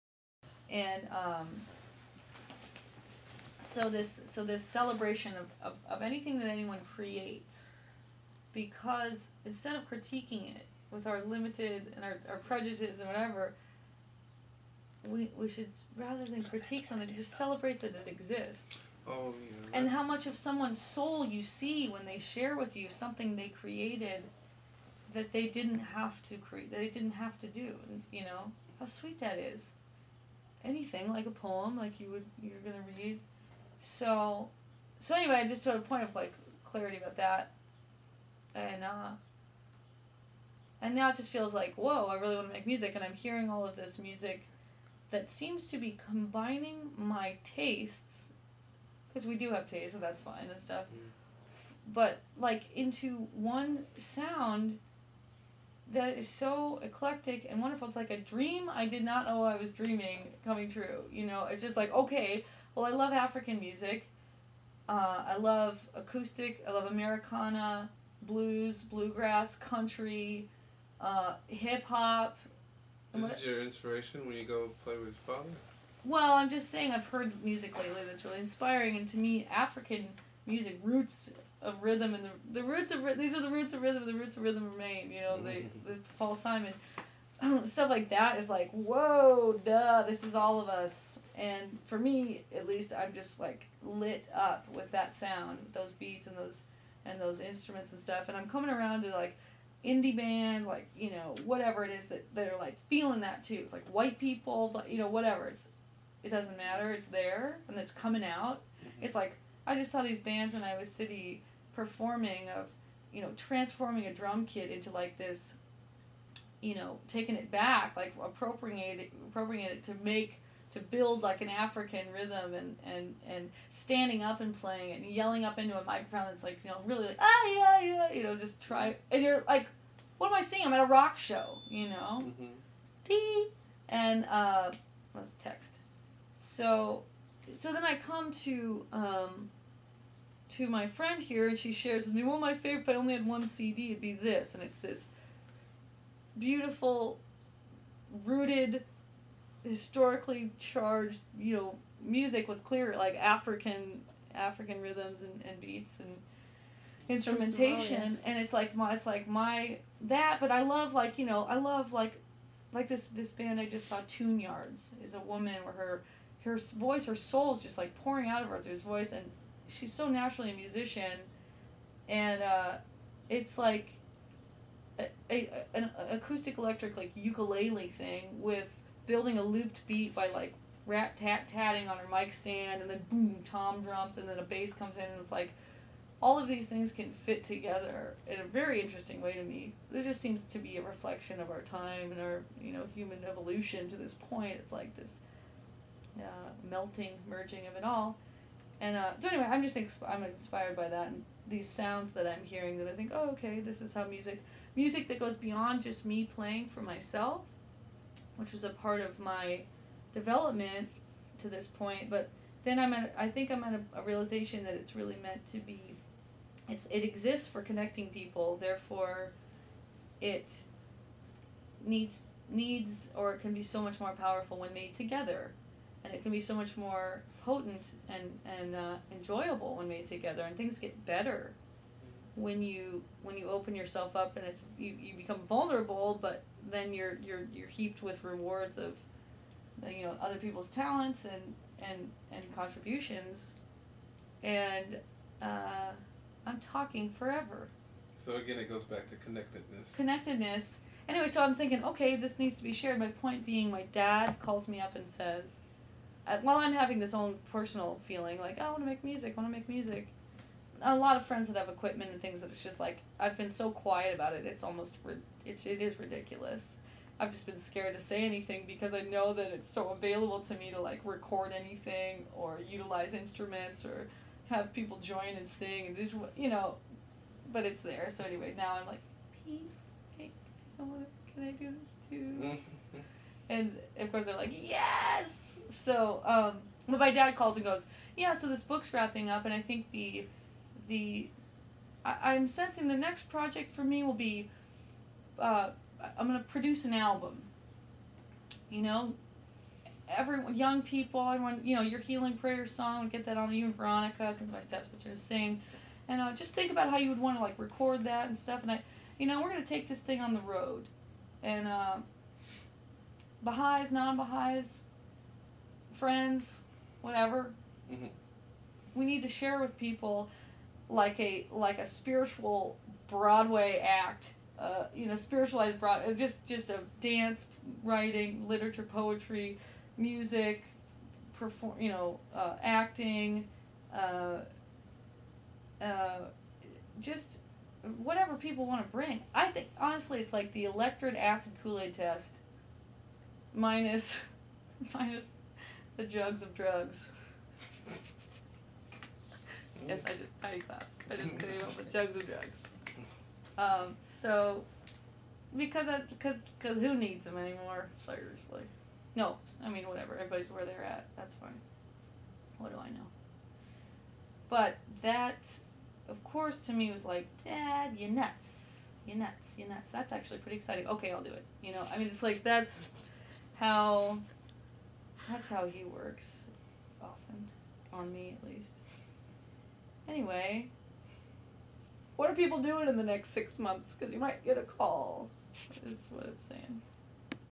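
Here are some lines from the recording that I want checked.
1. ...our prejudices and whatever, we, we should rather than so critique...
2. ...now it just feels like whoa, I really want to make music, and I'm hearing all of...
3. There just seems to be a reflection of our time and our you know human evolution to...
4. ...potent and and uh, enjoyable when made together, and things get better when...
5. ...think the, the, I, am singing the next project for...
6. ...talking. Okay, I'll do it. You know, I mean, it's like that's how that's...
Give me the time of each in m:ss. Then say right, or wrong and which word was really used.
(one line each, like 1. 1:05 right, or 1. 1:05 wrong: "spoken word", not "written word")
1. 0:12 right
2. 0:40 right
3. 3:09 right
4. 3:47 right
5. 4:49 wrong: "sensing", not "singing"
6. 6:10 wrong: "exciting", not "talking".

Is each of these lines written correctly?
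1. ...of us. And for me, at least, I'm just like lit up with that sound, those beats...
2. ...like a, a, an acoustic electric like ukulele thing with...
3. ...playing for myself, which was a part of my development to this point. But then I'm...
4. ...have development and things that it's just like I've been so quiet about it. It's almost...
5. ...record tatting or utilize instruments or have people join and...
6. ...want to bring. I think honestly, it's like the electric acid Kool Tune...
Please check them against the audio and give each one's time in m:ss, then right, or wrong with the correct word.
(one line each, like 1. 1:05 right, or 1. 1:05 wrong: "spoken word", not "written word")
1. 1:30 right
2. 2:53 right
3. 3:26 right
4. 4:21 wrong: "equipment", not "development"
5. 4:31 wrong: "anything", not "tatting"
6. 5:38 wrong: "Aid", not "Tune".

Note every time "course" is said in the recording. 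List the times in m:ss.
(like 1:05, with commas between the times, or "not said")
4:44, 6:06.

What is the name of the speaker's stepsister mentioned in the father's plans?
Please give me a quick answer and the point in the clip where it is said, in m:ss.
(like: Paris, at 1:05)
Veronica, at 5:03.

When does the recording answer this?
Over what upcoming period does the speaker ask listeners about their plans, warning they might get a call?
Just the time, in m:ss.
6:23.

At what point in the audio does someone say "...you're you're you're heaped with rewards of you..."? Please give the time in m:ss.
3:56.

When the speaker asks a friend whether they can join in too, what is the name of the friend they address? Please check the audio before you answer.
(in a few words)
Pete.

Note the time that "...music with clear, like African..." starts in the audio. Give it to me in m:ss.
2:32.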